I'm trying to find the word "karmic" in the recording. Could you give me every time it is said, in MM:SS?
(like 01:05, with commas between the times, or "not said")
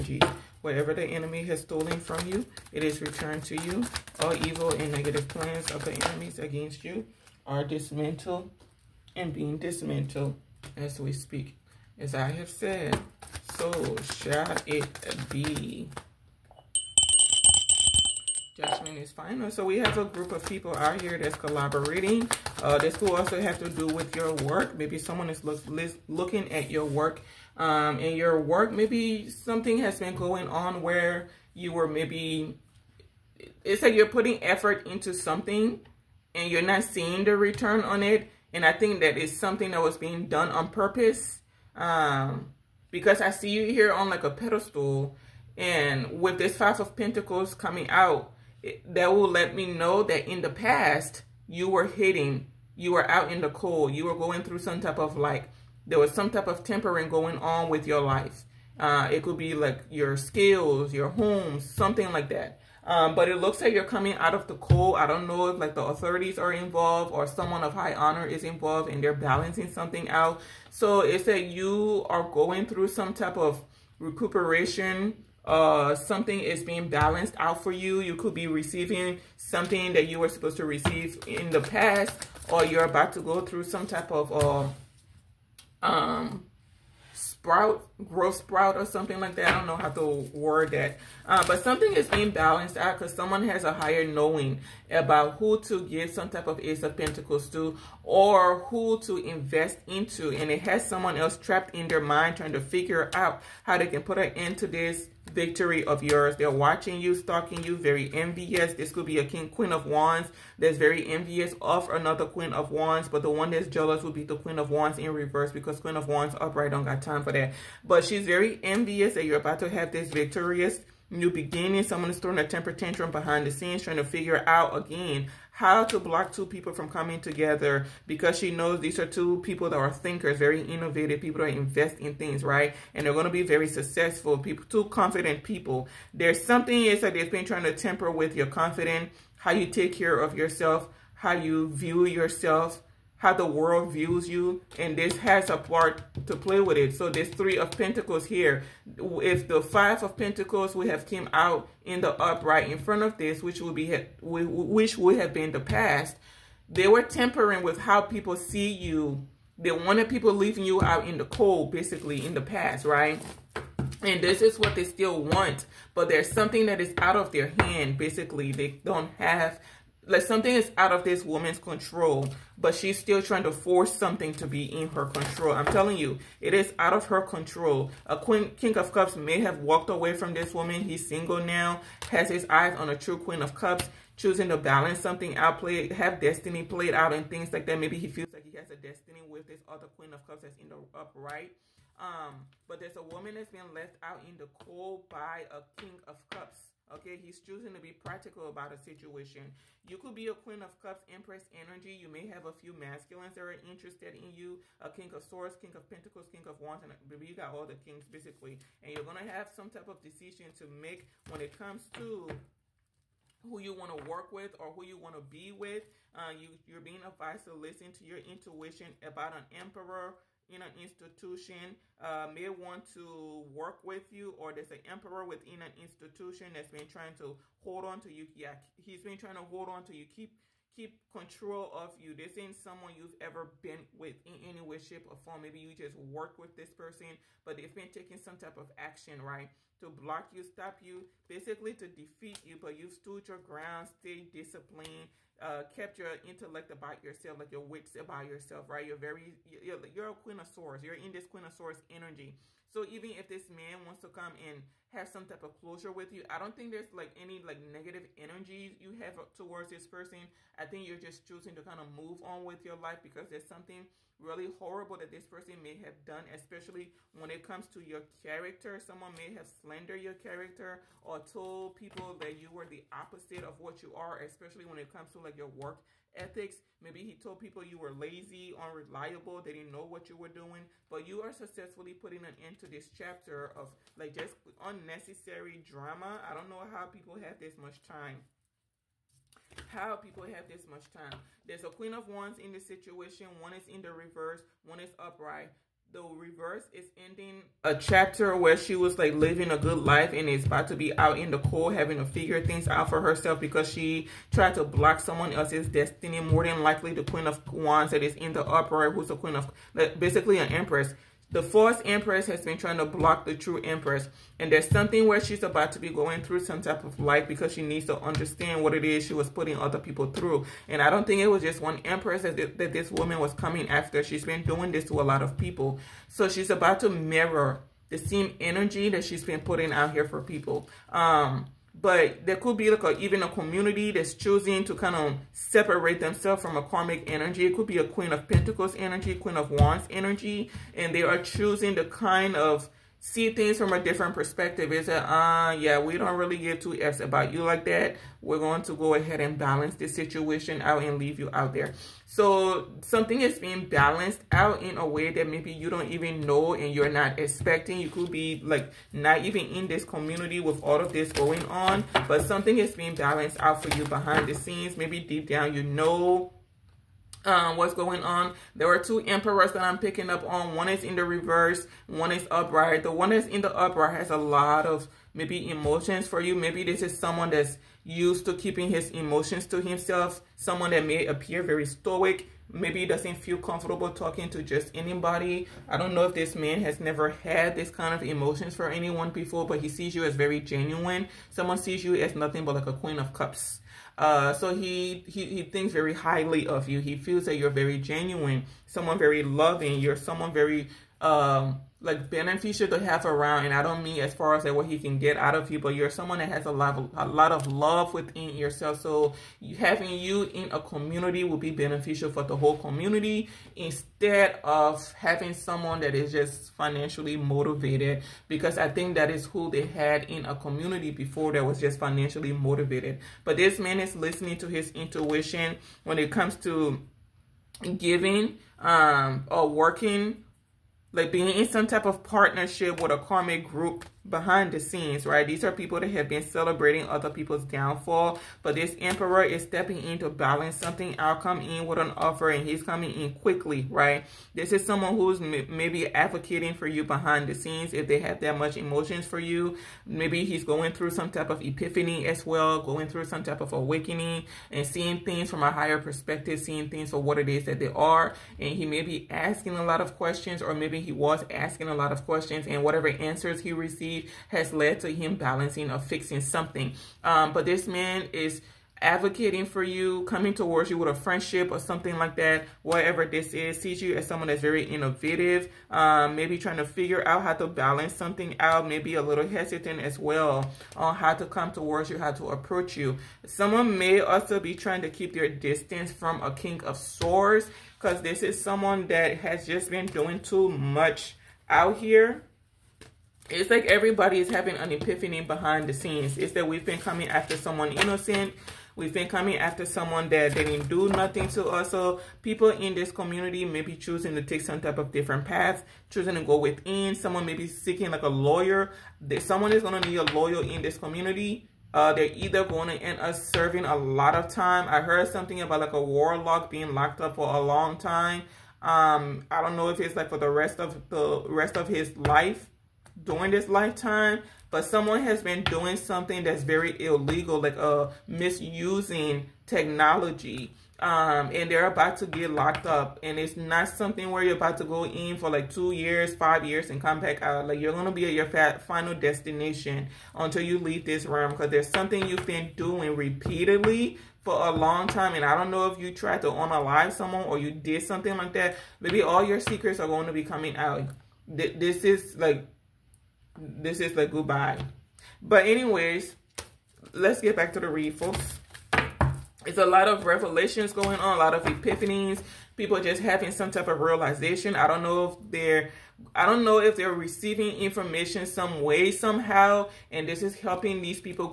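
05:36, 07:12.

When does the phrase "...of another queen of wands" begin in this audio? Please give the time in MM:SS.
01:51.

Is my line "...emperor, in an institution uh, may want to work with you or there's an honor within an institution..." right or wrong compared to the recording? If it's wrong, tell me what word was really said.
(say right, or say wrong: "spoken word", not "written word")
wrong: "emperor", not "honor".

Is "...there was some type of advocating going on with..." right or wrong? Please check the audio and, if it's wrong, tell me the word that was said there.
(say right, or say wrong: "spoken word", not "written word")
wrong: "tempering", not "advocating".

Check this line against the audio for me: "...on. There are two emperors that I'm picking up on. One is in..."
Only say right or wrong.
right.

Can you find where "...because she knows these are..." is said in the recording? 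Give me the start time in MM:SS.
02:08.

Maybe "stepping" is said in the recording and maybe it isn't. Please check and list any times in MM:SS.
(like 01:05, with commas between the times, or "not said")
07:19.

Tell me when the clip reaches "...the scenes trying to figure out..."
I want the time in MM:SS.
02:03.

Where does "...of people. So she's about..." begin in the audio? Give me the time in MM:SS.
05:25.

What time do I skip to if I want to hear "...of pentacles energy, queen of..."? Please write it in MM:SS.
05:38.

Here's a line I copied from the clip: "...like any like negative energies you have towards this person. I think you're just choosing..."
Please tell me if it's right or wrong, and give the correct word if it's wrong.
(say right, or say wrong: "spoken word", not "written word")
right.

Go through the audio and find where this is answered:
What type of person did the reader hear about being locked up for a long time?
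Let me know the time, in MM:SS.
08:35.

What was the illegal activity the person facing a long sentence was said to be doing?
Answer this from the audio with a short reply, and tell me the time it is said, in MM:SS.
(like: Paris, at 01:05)
misusing technology, at 08:48.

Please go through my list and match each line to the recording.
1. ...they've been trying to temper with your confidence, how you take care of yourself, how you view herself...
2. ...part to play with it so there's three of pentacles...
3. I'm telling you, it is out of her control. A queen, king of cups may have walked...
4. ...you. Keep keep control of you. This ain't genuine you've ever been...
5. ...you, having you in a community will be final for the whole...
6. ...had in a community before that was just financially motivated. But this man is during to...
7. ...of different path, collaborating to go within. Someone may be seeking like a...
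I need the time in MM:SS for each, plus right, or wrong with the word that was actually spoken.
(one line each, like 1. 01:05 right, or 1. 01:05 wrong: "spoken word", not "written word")
1. 02:17 wrong: "yourself", not "herself"
2. 02:25 right
3. 02:55 right
4. 03:49 wrong: "someone", not "genuine"
5. 06:49 wrong: "beneficial", not "final"
6. 06:59 wrong: "listening", not "during"
7. 08:24 wrong: "choosing", not "collaborating".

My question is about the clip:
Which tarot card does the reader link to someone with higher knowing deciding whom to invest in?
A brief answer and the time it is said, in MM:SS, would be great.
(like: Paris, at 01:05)
Ace of Pentacles, at 01:36.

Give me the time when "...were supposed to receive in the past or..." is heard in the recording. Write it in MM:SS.
01:20.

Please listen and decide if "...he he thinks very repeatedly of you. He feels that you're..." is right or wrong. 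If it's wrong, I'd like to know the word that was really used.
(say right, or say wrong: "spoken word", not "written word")
wrong: "highly", not "repeatedly".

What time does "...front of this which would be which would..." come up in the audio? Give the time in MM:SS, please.
02:32.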